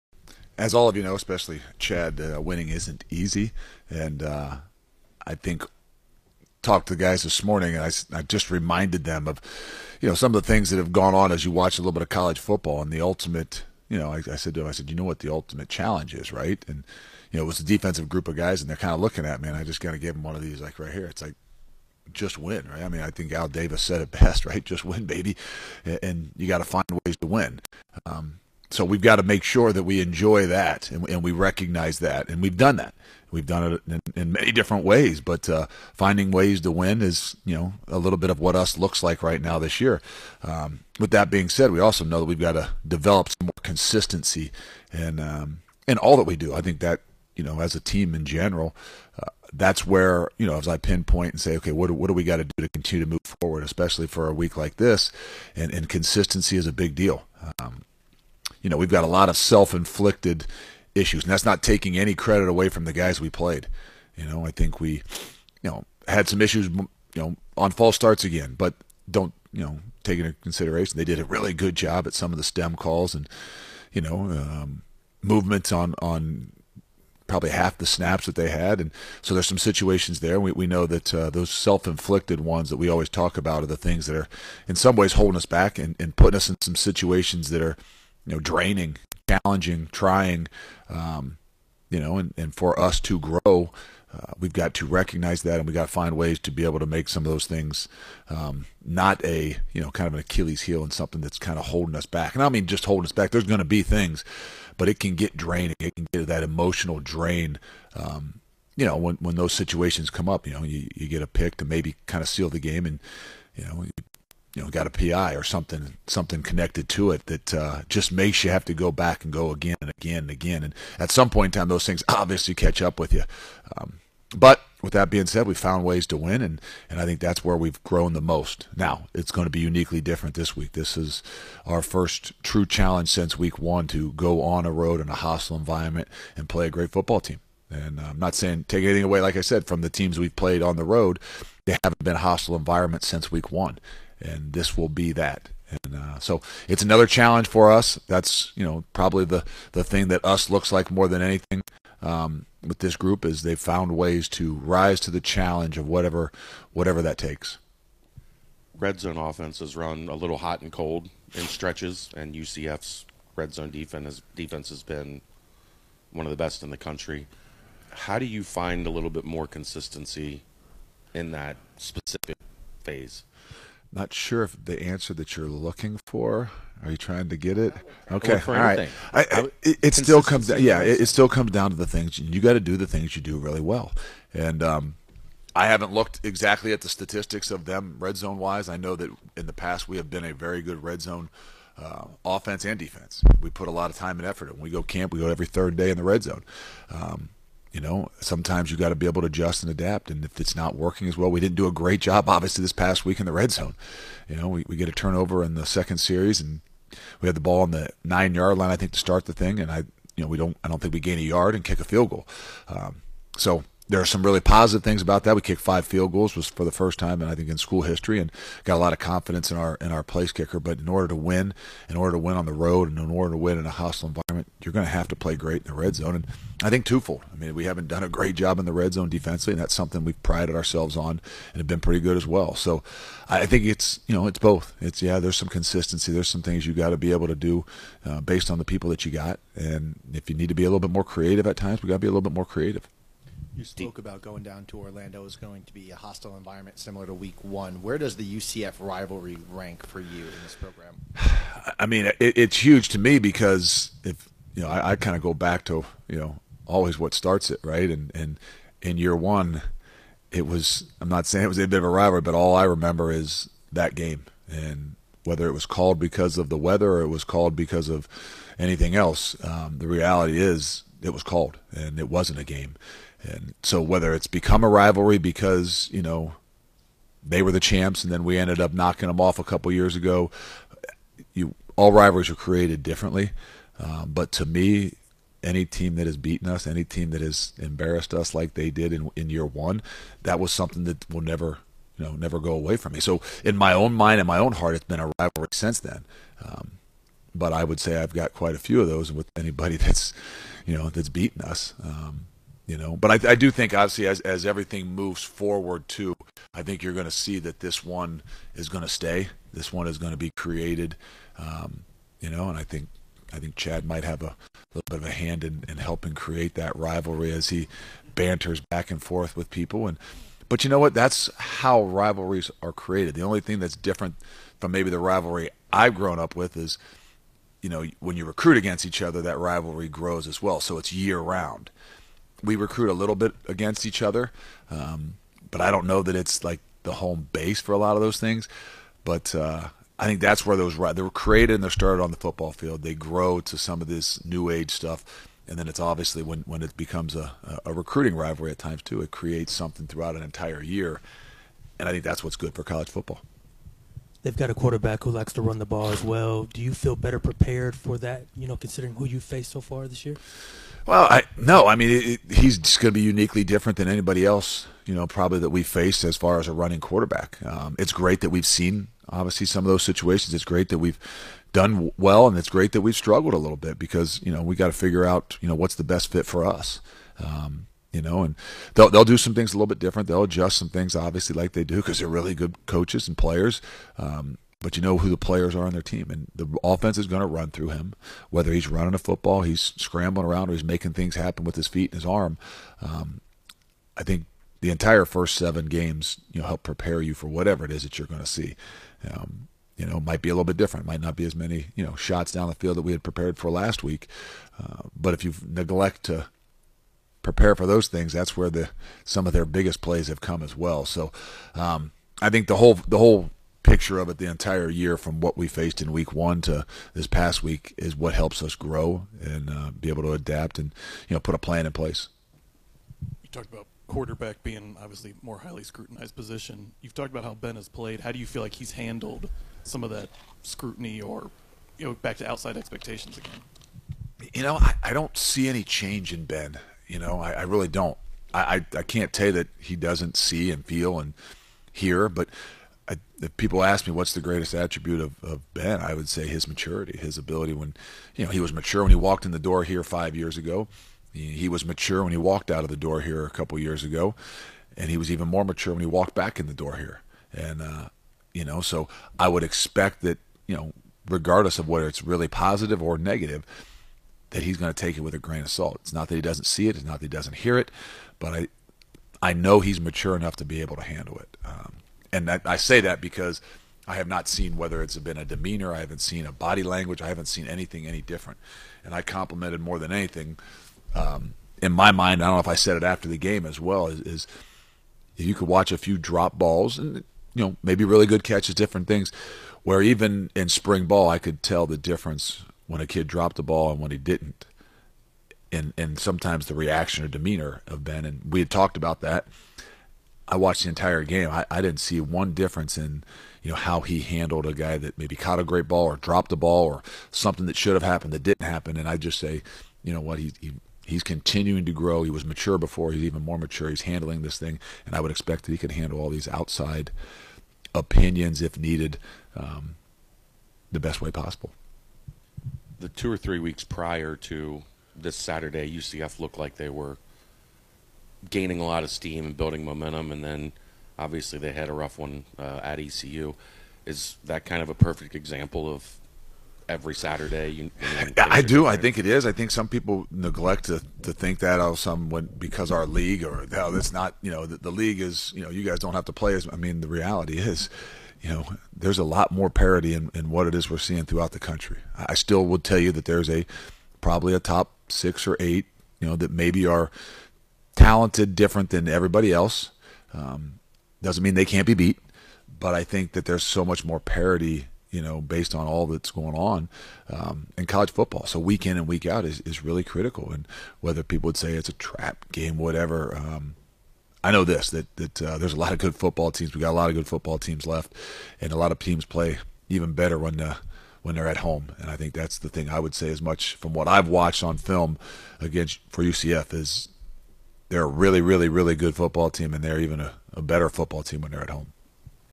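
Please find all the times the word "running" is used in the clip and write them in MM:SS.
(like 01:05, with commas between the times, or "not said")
06:06, 06:28.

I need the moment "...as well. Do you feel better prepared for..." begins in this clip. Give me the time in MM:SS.
05:55.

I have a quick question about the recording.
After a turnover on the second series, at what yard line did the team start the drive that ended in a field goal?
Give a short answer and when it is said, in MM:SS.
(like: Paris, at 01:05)
9, at 03:28.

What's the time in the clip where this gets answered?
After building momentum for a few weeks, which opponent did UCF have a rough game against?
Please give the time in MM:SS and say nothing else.
08:52.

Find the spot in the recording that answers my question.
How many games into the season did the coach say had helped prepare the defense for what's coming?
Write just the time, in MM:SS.
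06:35.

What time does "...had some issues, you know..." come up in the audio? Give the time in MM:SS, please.
01:06.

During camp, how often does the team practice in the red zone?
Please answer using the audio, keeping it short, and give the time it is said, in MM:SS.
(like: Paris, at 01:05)
Every third day, at 03:15.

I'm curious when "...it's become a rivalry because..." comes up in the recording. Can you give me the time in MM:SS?
04:34.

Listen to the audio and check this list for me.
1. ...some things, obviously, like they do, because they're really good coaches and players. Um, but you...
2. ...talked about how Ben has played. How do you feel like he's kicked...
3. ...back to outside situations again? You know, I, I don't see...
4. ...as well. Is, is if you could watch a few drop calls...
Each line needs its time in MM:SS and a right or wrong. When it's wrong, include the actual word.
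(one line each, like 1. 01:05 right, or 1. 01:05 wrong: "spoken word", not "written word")
1. 06:20 right
2. 07:06 wrong: "handled", not "kicked"
3. 07:11 wrong: "expectations", not "situations"
4. 08:03 wrong: "balls", not "calls".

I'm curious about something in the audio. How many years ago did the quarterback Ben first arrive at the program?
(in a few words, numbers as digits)
5.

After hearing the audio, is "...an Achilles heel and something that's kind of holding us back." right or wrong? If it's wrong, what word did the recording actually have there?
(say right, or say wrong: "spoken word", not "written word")
right.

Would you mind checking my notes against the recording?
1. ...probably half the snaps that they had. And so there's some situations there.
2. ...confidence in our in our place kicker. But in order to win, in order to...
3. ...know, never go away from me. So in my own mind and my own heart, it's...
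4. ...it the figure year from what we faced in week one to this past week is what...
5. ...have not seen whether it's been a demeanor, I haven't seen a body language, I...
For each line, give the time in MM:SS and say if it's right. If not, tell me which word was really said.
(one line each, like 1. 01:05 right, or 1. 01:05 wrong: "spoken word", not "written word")
1. 01:17 right
2. 03:38 right
3. 04:52 right
4. 06:54 wrong: "entire", not "figure"
5. 07:53 right.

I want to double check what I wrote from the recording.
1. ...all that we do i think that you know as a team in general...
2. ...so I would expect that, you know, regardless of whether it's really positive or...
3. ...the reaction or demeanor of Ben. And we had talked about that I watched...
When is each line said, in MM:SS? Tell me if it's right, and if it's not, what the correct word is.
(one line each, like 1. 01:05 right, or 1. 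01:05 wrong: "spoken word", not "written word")
1. 00:45 right
2. 07:38 right
3. 08:16 right.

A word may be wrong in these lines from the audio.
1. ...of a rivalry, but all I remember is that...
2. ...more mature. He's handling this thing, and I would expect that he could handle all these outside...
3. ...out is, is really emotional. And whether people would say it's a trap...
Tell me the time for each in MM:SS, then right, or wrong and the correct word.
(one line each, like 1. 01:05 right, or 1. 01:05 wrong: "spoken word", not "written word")
1. 04:21 right
2. 08:33 right
3. 09:29 wrong: "critical", not "emotional".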